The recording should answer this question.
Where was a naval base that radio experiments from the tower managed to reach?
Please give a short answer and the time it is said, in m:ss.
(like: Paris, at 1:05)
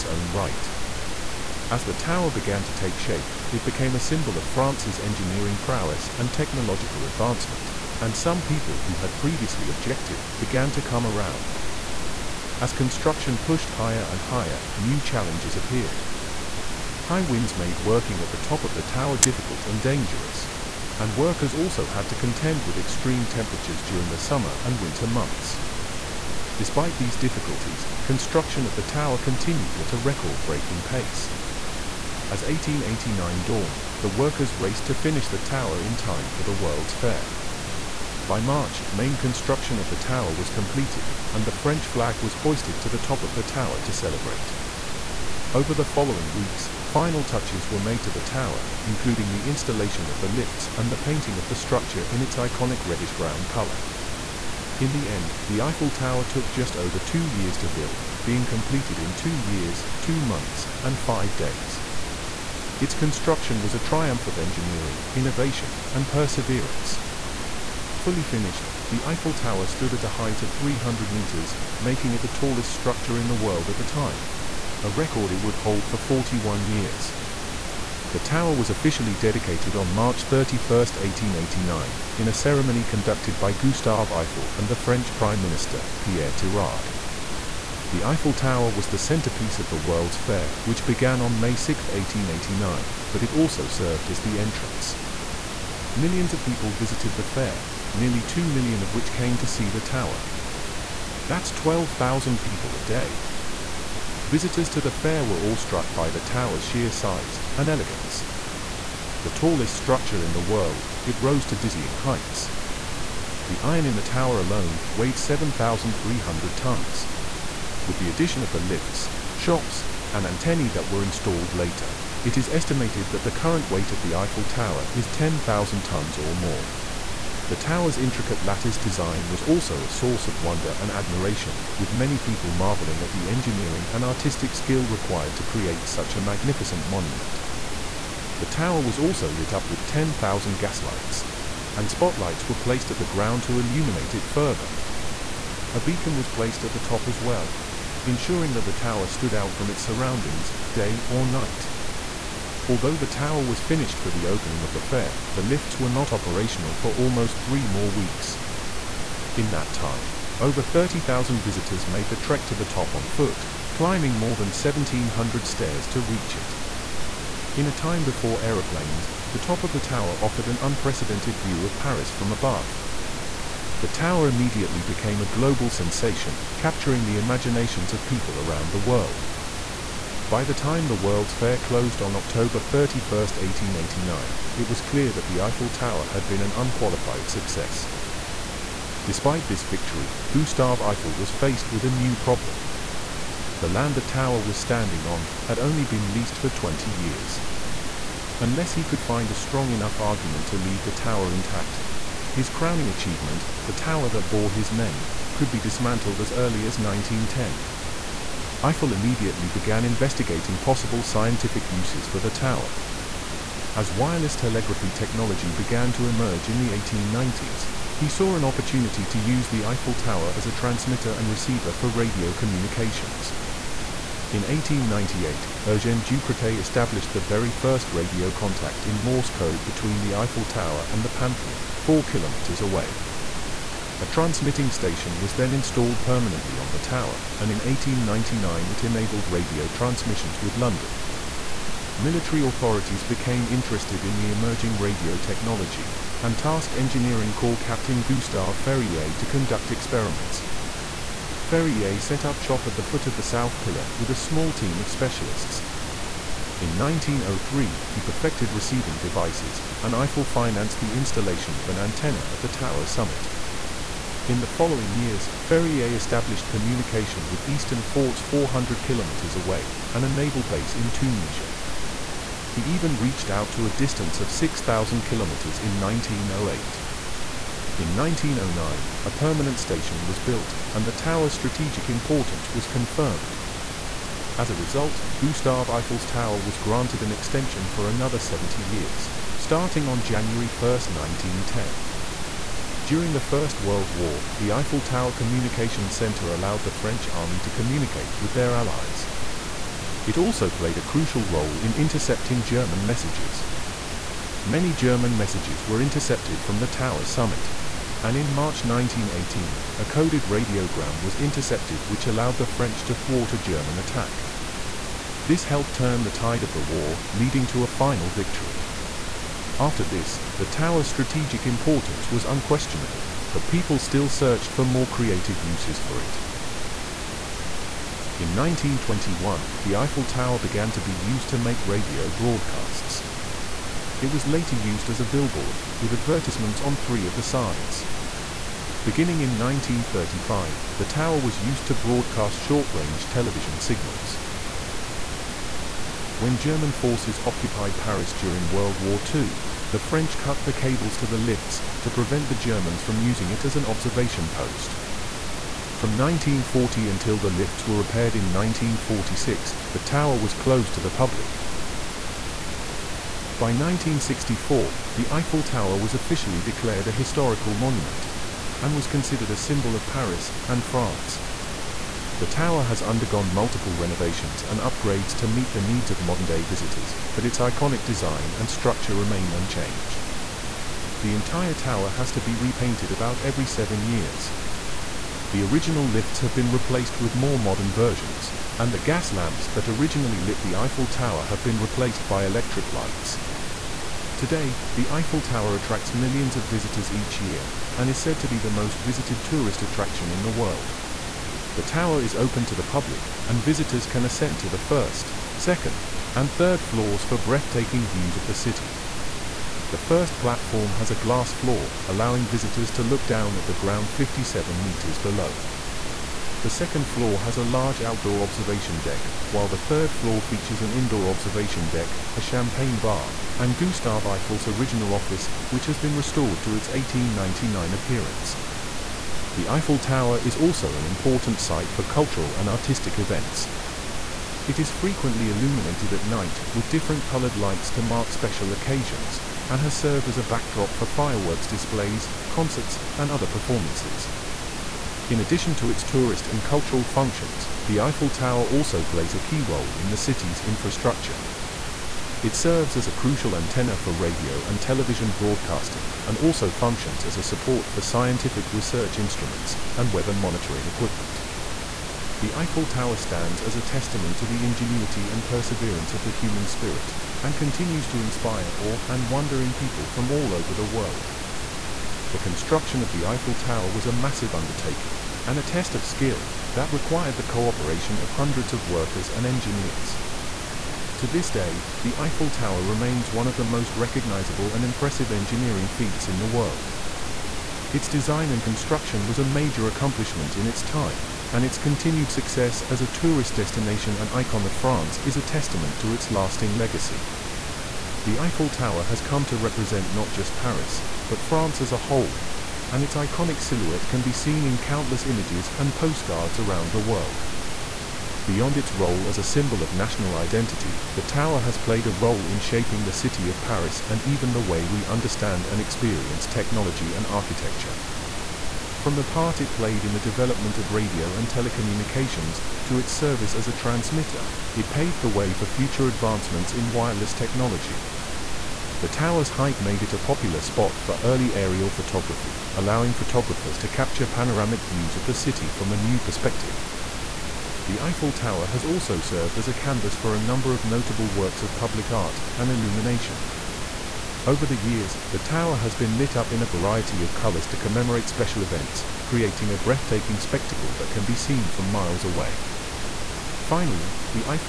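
Tunisia, at 4:30.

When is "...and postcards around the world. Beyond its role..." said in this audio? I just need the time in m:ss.
8:25.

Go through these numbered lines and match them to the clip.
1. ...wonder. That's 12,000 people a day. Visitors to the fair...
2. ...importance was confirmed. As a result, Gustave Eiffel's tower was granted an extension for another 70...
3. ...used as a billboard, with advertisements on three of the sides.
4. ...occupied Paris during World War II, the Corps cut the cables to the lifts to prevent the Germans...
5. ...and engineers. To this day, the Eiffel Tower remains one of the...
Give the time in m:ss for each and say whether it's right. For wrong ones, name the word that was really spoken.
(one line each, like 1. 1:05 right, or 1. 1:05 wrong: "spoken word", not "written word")
1. 1:39 wrong: "tower", not "wonder"
2. 4:41 right
3. 5:34 right
4. 5:47 wrong: "French", not "Corps"
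5. 7:59 right.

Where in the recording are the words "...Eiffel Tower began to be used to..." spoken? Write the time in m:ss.
5:29.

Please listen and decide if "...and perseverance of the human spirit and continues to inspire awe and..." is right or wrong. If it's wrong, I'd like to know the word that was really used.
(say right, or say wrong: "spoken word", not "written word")
right.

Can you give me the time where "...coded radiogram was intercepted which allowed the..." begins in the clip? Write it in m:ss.
5:09.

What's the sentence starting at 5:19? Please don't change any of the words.
After this, the tower's strategic importance was unquestionable, but people still searched for more creative uses for it.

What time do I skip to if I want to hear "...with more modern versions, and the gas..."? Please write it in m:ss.
6:27.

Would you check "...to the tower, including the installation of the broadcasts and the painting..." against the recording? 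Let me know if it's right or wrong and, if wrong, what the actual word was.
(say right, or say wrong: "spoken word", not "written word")
wrong: "lifts", not "broadcasts".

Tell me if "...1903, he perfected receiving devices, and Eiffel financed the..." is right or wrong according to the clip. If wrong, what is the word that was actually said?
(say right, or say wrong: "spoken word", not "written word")
right.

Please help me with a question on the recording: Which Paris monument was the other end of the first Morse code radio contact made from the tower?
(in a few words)
Pantheon.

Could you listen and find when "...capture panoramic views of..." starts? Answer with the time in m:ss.
8:53.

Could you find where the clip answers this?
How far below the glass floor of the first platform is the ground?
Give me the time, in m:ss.
6:53.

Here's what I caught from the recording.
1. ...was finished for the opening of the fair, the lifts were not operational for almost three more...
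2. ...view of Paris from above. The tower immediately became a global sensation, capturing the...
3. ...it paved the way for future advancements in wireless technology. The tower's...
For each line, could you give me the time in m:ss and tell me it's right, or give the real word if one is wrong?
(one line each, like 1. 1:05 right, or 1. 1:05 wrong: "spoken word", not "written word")
1. 2:33 right
2. 2:51 right
3. 8:44 right.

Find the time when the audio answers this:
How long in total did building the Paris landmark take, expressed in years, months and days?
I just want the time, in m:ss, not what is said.
0:59.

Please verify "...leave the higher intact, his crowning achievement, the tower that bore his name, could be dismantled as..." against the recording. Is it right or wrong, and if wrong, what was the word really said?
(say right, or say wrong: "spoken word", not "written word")
wrong: "tower", not "higher".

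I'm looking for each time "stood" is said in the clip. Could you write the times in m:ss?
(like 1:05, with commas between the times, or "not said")
1:09, 2:29.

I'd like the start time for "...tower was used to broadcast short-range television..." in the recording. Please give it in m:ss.
5:40.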